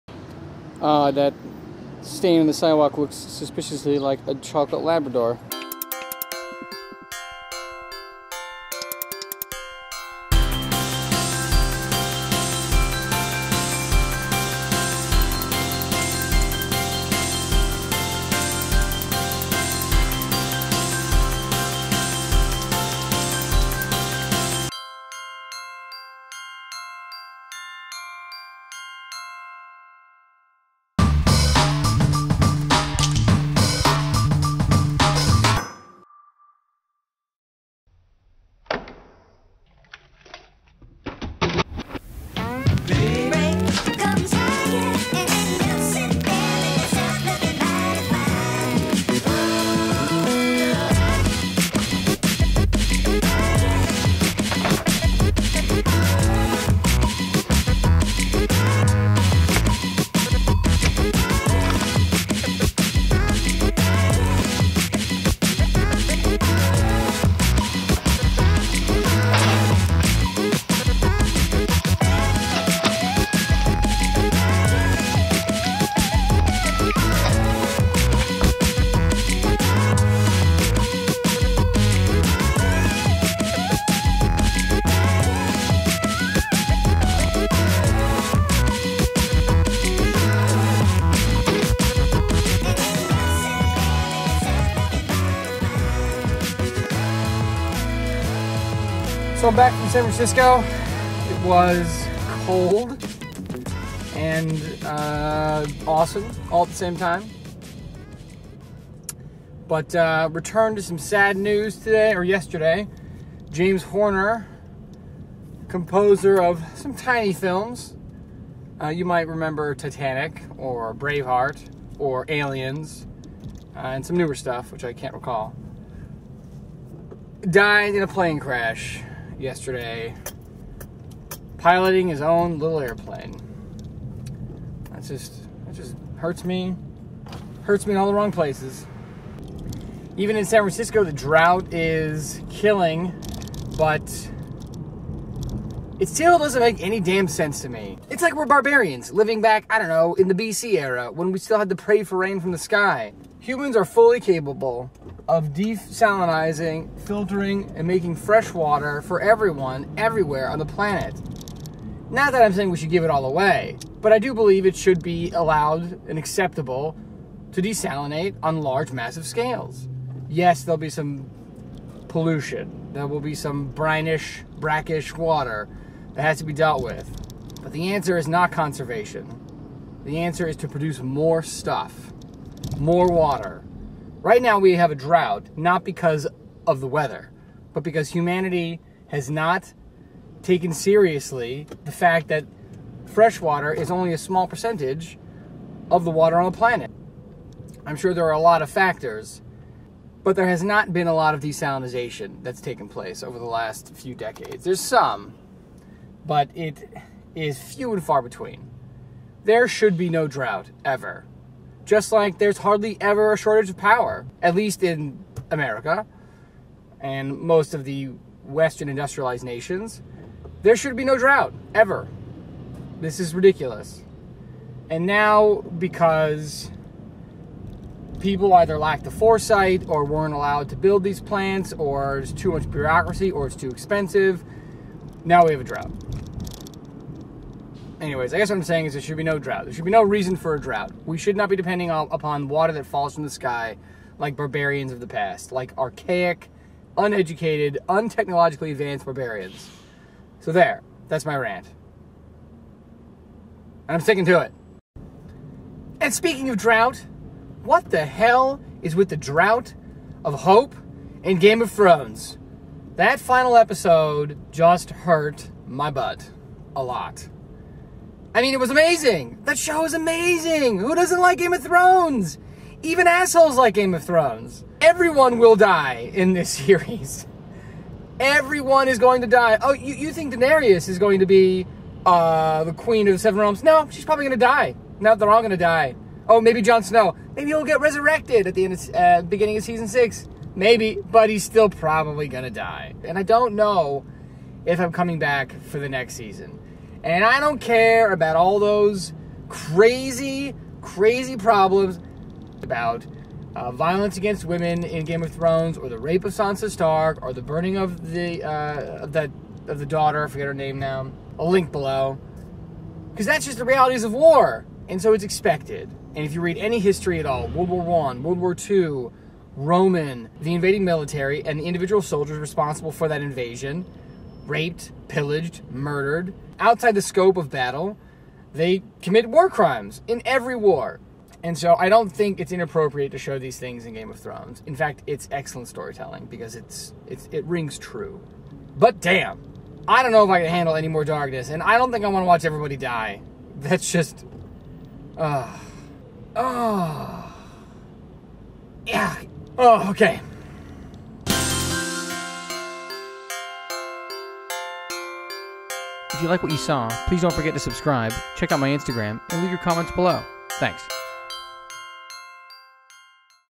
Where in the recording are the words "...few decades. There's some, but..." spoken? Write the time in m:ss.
3:23.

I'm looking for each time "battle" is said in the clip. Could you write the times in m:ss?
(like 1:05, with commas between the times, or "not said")
5:27.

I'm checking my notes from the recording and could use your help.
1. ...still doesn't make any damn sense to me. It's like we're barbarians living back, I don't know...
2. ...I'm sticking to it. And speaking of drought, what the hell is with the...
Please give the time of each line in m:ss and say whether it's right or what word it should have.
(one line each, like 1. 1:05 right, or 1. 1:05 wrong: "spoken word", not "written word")
1. 2:26 right
2. 4:13 right.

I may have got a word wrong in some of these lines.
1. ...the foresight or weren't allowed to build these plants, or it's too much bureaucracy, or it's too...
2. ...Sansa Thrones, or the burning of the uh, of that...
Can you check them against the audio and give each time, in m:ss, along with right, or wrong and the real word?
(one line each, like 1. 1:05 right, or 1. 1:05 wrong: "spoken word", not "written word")
1. 3:49 right
2. 5:06 wrong: "Stark", not "Thrones".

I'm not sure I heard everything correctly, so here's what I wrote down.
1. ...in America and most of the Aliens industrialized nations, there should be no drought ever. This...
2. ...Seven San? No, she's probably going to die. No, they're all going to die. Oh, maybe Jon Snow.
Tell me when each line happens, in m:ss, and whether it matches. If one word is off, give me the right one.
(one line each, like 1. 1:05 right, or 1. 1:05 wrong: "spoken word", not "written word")
1. 3:34 wrong: "Western", not "Aliens"
2. 4:43 wrong: "Realms", not "San".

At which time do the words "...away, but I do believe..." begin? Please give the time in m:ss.
2:43.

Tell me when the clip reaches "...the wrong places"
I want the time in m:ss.
2:18.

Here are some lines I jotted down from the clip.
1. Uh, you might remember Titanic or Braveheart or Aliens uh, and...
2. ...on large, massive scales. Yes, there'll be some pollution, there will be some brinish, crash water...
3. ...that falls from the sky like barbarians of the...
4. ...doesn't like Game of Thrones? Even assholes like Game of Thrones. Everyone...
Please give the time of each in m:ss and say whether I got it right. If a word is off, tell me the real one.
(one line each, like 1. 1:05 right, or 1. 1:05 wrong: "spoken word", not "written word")
1. 1:58 right
2. 2:48 wrong: "brackish", not "crash"
3. 4:02 right
4. 4:30 right.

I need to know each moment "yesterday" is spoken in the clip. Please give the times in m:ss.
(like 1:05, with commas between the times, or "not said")
1:52, 2:09.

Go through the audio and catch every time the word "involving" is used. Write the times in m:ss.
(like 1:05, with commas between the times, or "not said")
not said.